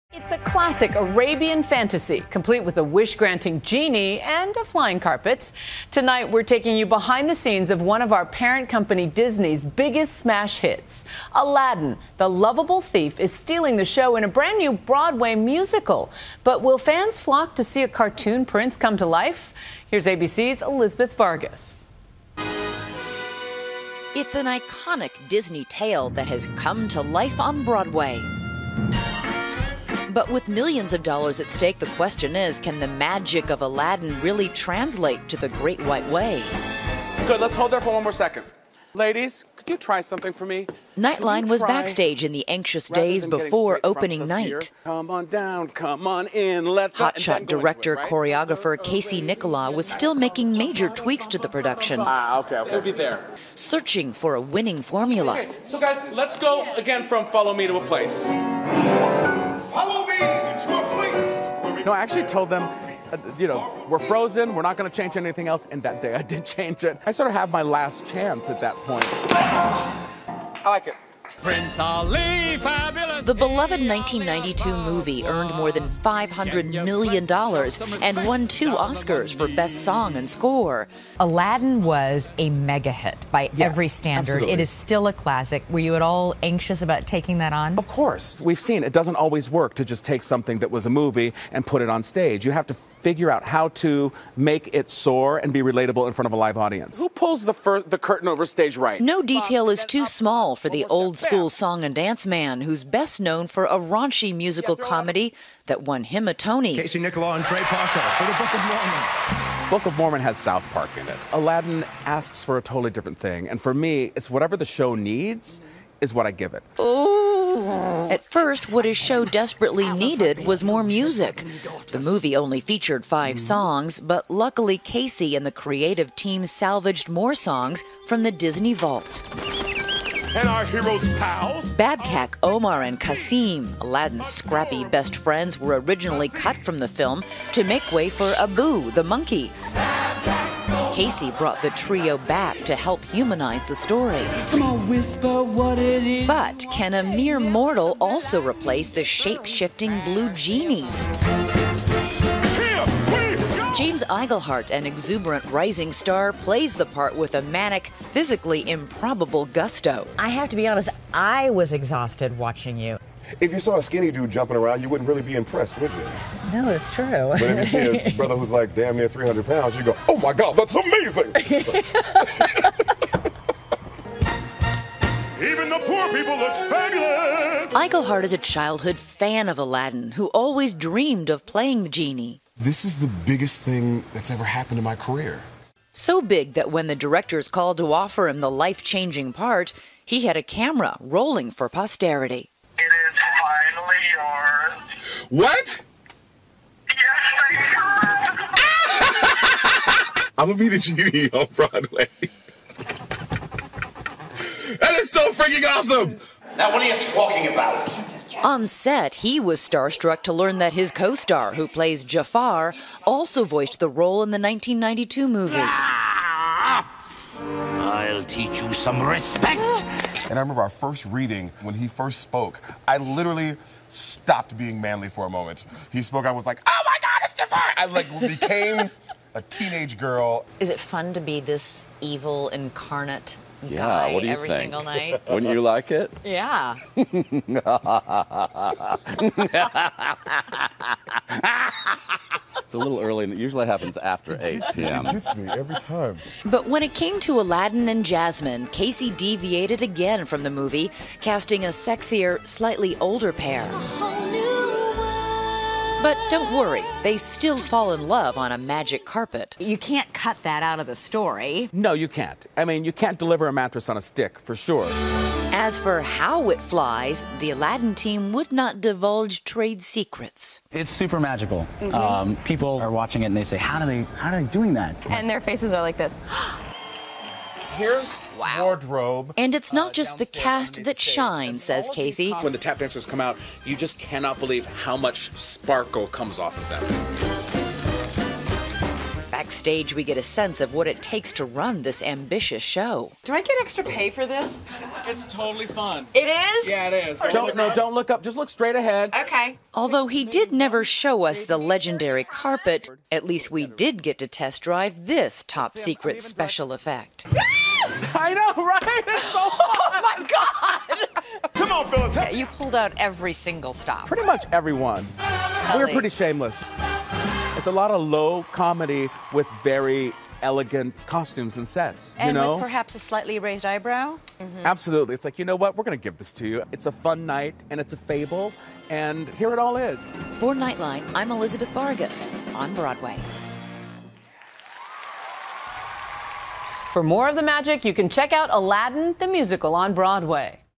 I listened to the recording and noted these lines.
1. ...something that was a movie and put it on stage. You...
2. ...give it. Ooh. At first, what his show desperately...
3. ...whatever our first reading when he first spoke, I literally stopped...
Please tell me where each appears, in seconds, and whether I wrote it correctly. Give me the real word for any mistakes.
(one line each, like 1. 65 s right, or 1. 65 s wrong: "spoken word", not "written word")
1. 90 s right
2. 116 s right
3. 220 s wrong: "remember", not "whatever".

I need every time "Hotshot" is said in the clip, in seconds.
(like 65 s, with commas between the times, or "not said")
46 s.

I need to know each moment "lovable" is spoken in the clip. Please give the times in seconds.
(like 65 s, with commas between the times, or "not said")
12 s.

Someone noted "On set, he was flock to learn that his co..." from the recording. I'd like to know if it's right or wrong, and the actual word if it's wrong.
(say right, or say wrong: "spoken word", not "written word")
wrong: "starstruck", not "flock".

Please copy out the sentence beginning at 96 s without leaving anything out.
Who pulls the, the curtain over stage right?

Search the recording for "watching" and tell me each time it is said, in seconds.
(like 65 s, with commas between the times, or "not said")
162 s, 273 s.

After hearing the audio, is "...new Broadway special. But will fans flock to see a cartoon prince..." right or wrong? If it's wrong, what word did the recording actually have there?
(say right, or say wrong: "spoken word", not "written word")
wrong: "musical", not "special".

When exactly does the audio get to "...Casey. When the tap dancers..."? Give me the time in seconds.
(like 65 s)
281 s.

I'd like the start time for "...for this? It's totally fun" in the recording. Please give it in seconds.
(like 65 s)
294 s.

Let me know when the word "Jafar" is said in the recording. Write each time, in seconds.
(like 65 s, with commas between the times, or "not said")
212 s, 227 s.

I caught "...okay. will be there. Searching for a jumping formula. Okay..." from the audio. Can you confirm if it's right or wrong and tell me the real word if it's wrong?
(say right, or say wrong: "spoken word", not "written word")
wrong: "winning", not "jumping".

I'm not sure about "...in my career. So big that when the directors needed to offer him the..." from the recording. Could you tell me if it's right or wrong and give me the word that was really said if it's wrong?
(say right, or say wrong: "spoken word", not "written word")
wrong: "called", not "needed".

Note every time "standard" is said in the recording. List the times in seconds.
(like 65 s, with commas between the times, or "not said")
83 s.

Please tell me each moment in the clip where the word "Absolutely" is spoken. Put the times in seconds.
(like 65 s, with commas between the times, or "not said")
84 s, 324 s.